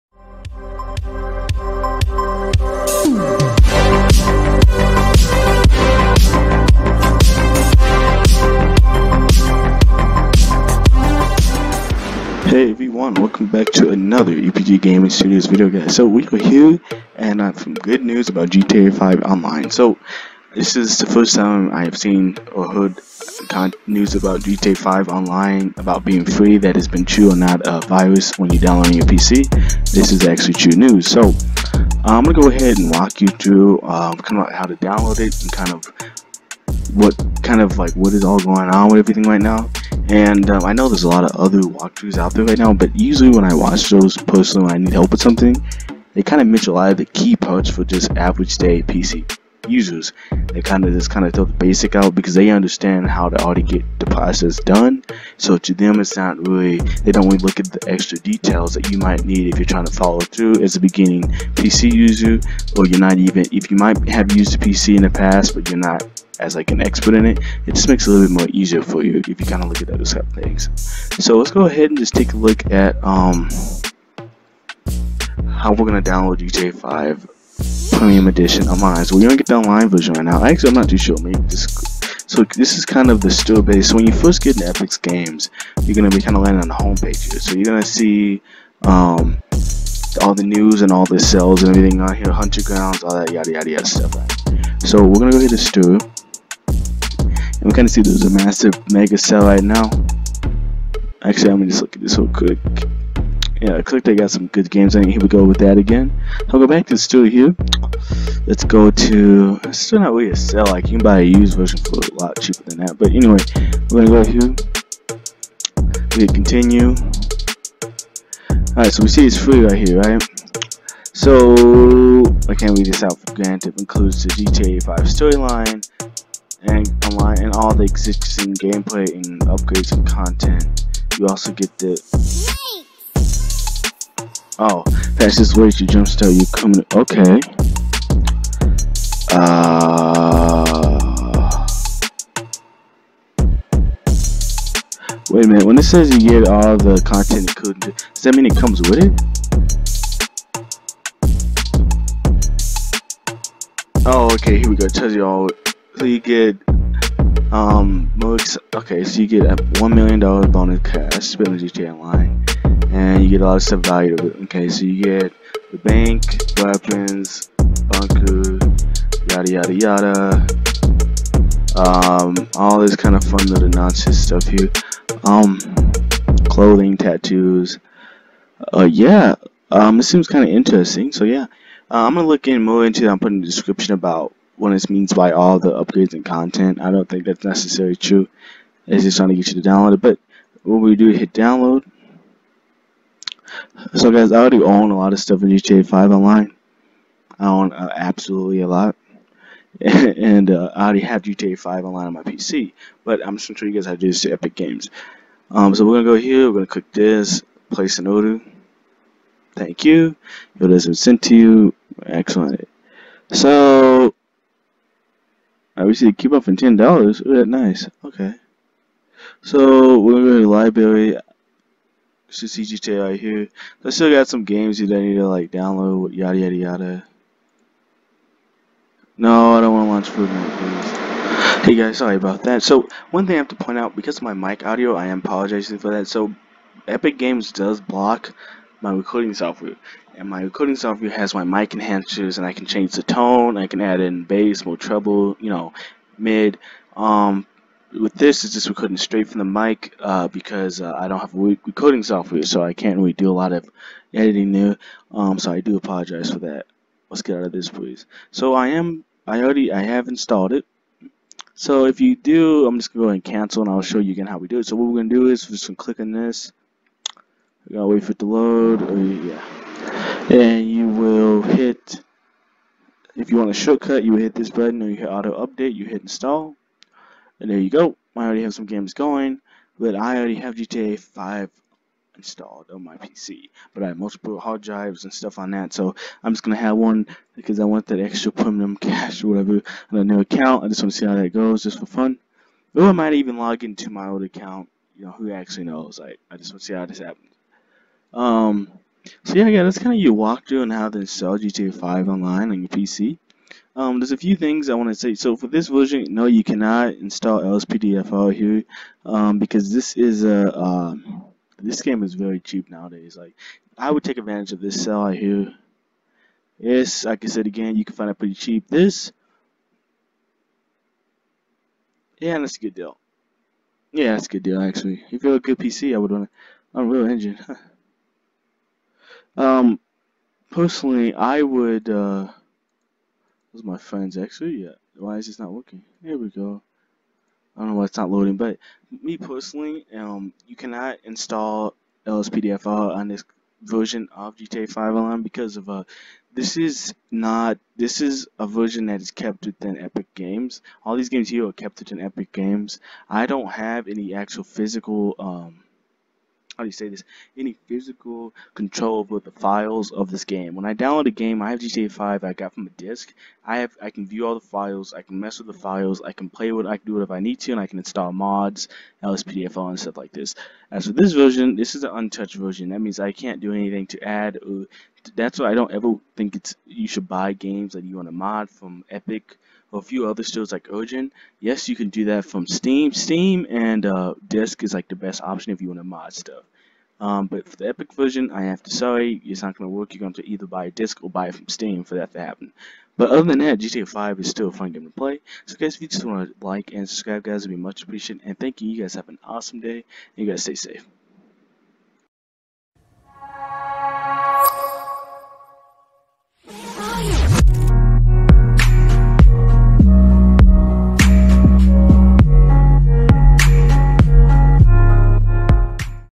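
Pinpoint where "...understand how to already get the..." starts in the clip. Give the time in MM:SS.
00:52.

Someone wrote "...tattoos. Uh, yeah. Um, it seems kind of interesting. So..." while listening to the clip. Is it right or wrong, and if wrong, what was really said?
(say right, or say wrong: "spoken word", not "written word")
right.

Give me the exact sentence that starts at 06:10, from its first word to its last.
As for this version, this is an untouched version.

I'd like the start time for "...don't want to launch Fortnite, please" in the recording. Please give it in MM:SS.
03:49.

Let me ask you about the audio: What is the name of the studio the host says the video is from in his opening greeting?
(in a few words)
EPG Gaming Studios.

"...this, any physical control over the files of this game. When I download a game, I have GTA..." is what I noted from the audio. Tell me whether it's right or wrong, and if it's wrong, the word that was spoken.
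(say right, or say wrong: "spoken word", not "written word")
right.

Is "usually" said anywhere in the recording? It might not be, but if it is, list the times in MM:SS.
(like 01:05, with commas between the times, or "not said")
00:42.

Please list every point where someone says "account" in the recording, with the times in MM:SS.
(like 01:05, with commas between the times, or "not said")
04:50, 04:54.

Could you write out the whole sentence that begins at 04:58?
Um, so yeah, yeah, that's kind of your walkthrough on how to install GTA 5 online on your PC.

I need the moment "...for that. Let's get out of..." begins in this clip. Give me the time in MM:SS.
04:16.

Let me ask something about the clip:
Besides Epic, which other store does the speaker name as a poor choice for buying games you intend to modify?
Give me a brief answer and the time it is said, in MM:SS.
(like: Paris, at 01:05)
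Origin, at 06:20.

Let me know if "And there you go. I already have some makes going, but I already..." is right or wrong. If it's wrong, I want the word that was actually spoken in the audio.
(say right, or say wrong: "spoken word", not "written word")
wrong: "games", not "makes".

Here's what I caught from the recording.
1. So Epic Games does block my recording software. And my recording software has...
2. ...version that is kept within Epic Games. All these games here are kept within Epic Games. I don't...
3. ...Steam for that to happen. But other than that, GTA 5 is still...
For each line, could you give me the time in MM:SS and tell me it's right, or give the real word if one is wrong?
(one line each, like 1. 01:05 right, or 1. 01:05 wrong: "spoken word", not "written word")
1. 03:56 right
2. 05:48 right
3. 06:31 right.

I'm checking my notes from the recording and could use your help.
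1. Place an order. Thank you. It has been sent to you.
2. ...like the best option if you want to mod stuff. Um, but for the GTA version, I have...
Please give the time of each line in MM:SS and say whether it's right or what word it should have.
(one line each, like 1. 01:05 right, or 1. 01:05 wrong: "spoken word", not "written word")
1. 03:27 right
2. 06:24 wrong: "Epic", not "GTA".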